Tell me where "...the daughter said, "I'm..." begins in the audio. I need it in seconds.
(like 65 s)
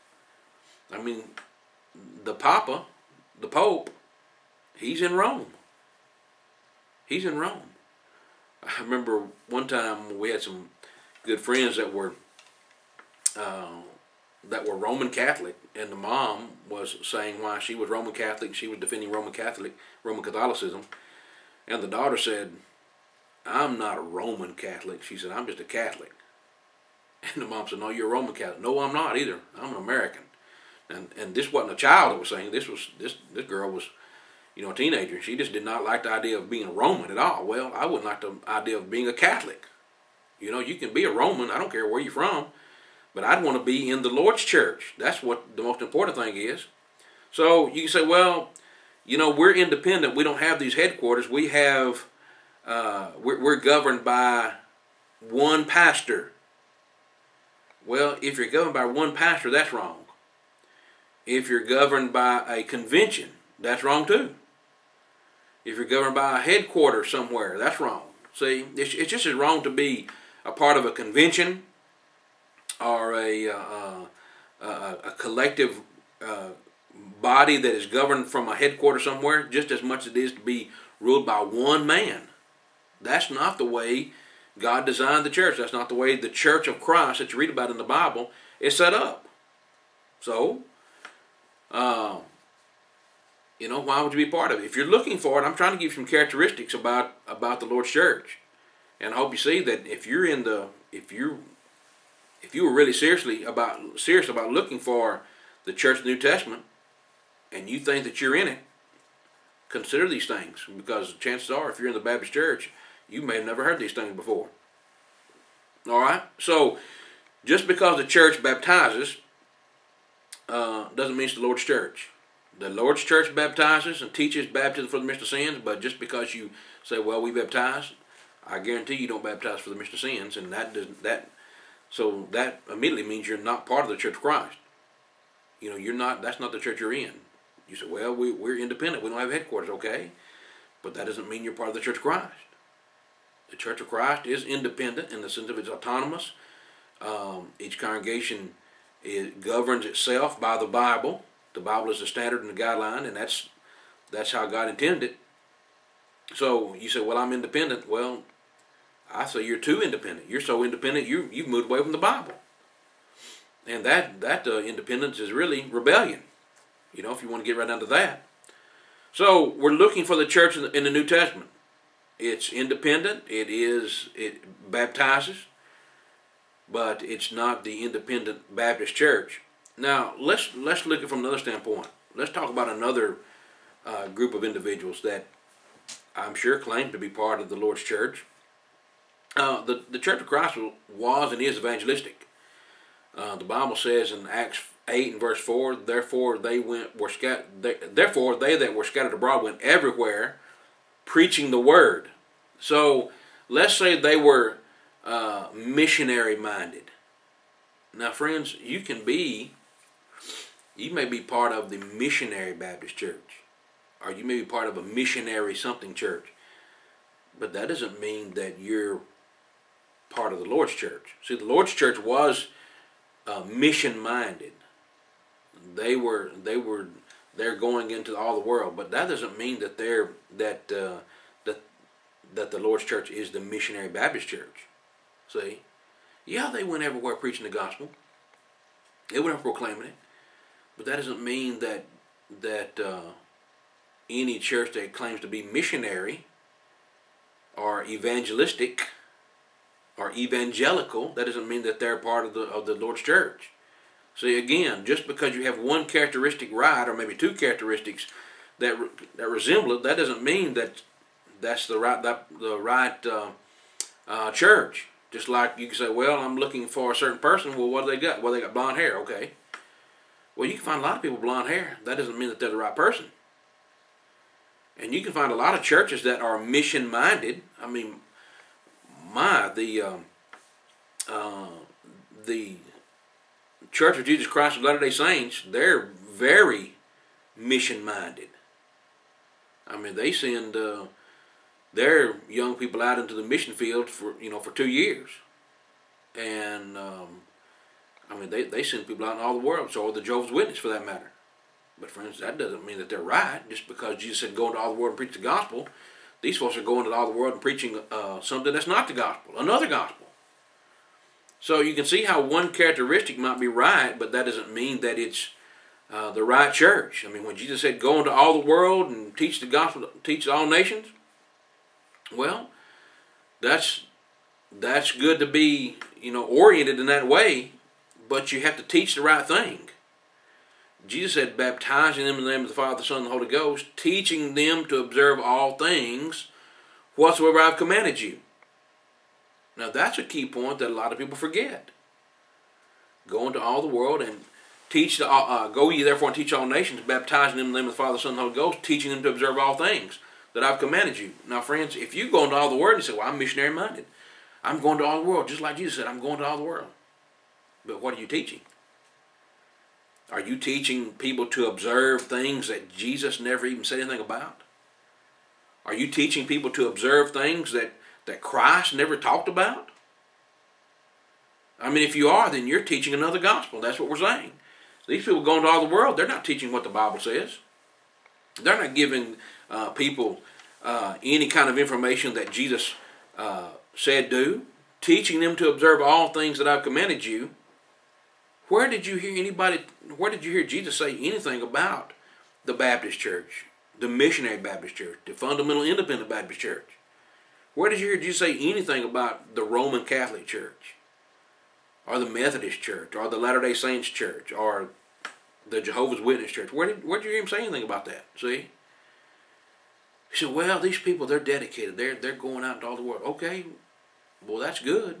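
21 s.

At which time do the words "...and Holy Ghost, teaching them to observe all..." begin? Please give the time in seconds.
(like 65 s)
348 s.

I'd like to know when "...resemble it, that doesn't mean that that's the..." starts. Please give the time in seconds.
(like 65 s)
259 s.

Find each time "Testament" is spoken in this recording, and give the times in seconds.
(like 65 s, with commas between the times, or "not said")
106 s, 171 s.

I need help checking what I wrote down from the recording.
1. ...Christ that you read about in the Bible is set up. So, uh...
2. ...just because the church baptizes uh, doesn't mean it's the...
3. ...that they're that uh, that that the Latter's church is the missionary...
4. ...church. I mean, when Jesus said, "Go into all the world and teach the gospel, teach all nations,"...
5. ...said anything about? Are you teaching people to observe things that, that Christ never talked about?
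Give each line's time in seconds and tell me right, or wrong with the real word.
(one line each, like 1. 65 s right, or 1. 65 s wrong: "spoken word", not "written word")
1. 86 s right
2. 117 s right
3. 229 s wrong: "Lord", not "Latter"
4. 316 s right
5. 363 s right.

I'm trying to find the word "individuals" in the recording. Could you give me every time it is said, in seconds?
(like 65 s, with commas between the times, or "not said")
184 s.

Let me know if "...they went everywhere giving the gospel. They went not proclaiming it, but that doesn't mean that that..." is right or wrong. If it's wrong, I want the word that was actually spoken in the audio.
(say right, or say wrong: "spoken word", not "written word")
wrong: "preaching", not "giving".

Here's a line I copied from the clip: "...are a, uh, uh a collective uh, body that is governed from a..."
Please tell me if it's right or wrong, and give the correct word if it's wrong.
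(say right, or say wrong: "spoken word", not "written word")
right.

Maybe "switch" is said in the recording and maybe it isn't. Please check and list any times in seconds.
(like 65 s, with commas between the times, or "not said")
not said.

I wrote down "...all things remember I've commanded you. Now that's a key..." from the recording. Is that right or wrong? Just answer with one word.
wrong.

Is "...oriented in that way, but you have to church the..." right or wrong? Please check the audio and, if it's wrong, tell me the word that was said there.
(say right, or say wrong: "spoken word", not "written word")
wrong: "teach", not "church".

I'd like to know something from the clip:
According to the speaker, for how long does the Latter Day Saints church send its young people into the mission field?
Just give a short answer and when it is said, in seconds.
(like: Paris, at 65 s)
2 years, at 294 s.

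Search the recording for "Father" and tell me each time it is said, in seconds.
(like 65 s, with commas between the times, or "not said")
332 s, 347 s.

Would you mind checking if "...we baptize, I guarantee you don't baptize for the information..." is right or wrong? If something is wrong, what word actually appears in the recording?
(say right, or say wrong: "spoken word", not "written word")
wrong: "remission", not "information".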